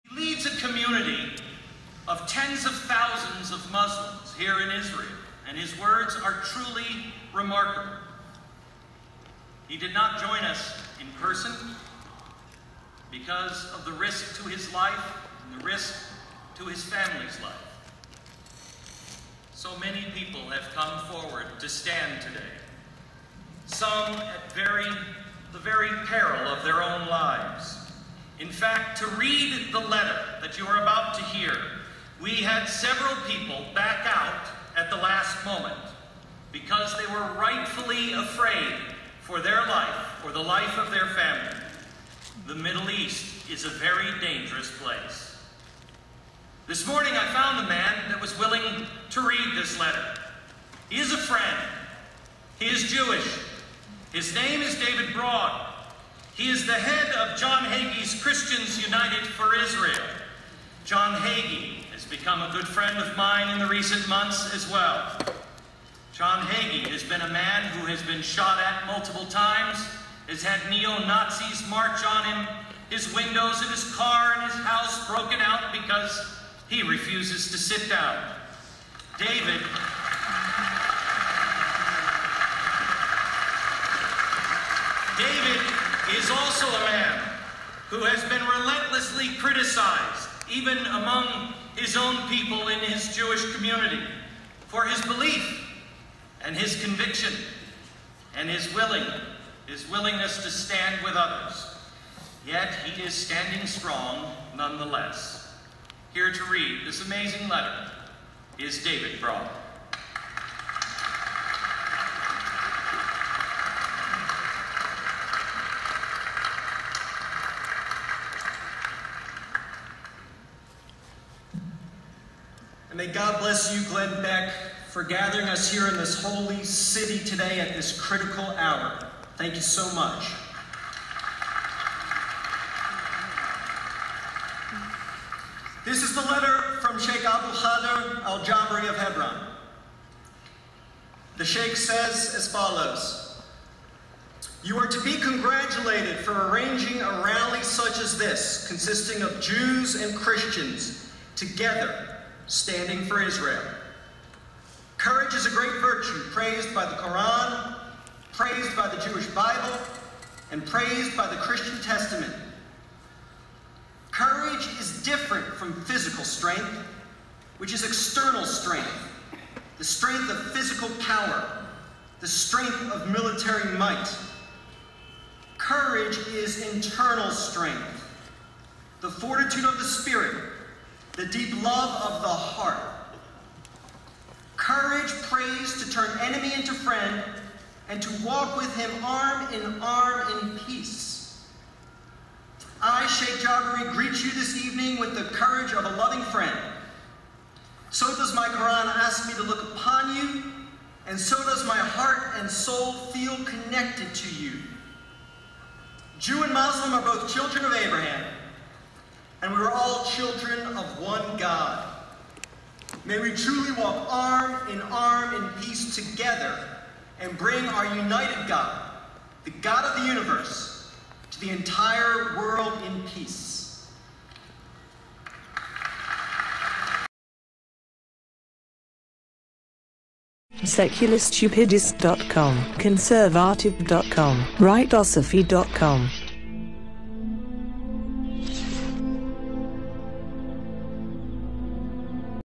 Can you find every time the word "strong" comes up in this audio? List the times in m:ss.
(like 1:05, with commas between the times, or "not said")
1:43.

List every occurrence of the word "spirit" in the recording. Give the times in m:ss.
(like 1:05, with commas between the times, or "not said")
2:59.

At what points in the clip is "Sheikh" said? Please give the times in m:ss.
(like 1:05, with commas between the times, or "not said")
2:16, 2:21, 3:13.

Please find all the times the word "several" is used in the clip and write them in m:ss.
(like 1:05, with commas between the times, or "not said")
0:32.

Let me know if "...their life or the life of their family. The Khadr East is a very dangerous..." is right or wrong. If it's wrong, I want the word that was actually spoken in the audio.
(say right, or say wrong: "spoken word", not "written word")
wrong: "Middle", not "Khadr".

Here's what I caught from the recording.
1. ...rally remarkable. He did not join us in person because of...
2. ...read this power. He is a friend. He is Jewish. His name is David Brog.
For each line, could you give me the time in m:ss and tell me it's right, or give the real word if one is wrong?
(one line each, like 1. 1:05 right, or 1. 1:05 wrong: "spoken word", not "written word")
1. 0:06 wrong: "truly", not "rally"
2. 0:49 wrong: "letter", not "power".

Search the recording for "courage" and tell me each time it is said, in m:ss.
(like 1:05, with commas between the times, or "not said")
2:34, 2:44, 2:55, 3:04, 3:15.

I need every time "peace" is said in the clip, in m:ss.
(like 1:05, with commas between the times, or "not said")
3:10, 3:35, 3:43.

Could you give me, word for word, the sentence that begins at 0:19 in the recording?
So many people have come forward to stand today, some at very, the very peril of their own lives.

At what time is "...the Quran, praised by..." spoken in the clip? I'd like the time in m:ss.
2:36.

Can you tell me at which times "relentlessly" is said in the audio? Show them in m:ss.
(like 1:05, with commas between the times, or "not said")
1:28.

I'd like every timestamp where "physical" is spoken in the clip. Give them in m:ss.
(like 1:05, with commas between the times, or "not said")
2:45, 2:50.